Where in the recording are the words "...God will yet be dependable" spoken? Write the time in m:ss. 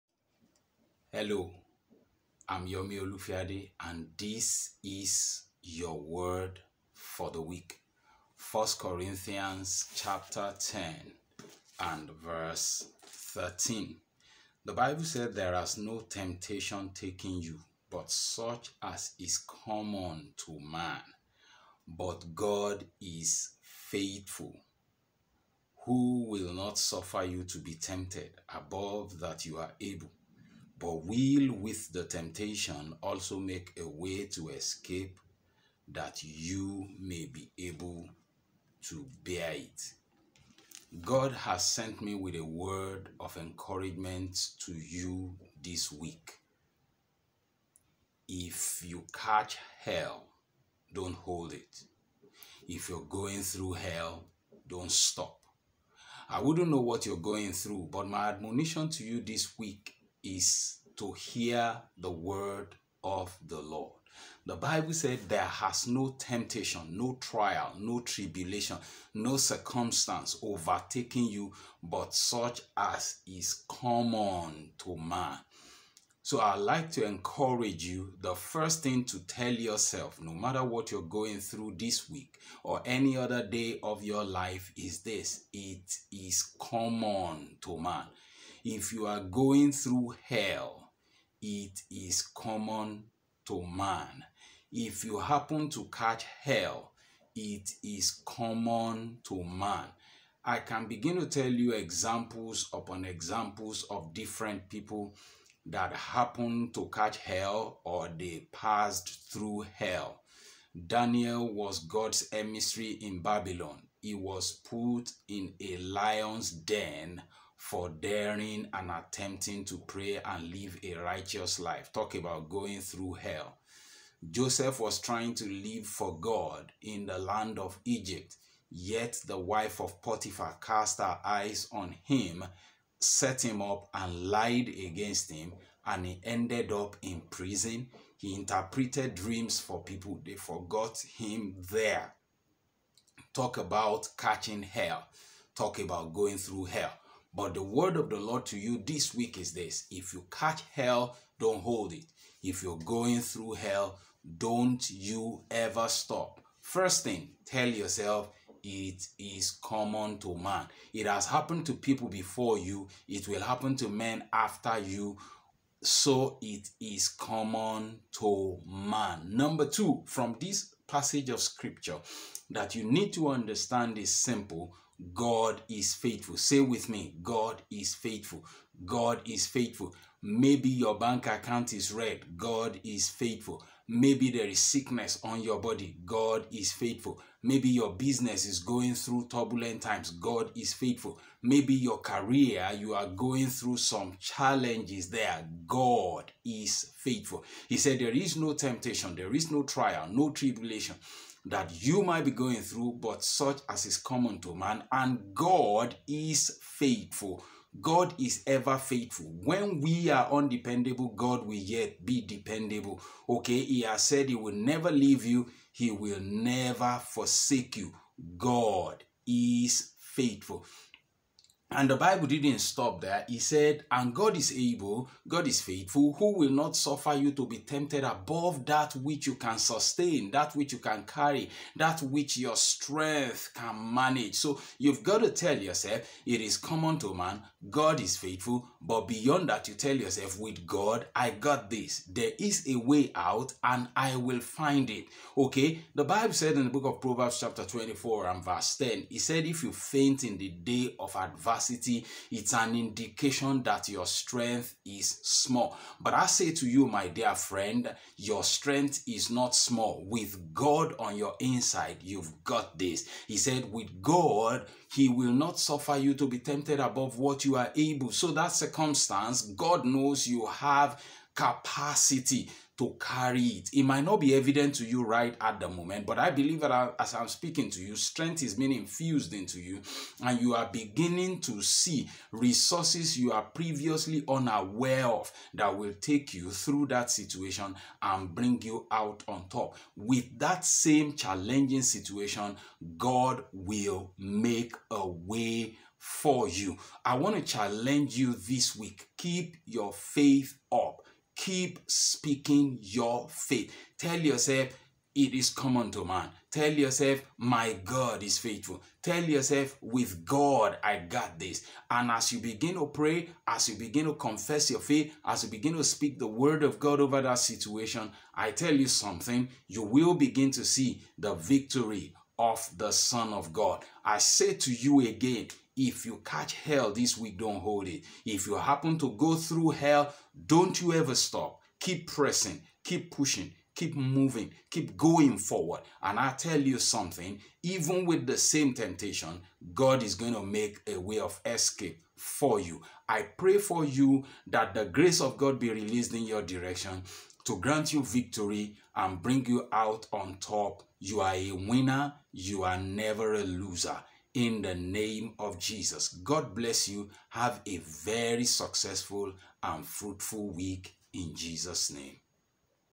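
3:31.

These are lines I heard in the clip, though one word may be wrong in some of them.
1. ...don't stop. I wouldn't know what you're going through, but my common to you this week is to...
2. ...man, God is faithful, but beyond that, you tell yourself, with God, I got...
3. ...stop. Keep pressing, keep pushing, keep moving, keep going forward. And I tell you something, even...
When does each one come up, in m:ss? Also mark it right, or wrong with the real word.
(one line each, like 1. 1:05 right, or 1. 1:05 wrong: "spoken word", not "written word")
1. 0:54 wrong: "admonition", not "common"
2. 3:57 right
3. 5:31 right.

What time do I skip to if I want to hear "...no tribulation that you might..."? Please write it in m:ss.
3:20.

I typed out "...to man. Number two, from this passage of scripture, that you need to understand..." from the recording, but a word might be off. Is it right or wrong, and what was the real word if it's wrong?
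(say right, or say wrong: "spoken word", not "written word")
right.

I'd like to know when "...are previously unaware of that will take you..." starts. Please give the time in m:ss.
4:43.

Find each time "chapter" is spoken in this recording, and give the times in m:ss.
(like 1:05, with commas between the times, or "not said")
0:09, 4:07.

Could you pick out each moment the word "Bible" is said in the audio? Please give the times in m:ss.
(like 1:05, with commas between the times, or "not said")
0:14, 1:04, 3:41, 4:06.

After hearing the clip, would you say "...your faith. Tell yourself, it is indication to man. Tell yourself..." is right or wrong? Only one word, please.
wrong.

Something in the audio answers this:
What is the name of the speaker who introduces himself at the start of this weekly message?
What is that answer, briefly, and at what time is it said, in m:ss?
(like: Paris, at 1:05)
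Yomi Olufiade, at 0:02.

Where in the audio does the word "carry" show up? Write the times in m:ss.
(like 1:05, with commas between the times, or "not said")
3:51, 4:32.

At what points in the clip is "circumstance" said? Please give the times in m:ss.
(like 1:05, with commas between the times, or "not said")
1:09, 4:28.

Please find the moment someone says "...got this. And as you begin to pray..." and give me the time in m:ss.
5:10.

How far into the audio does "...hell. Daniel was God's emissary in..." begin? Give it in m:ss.
1:49.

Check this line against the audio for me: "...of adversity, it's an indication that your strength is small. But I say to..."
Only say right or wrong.
right.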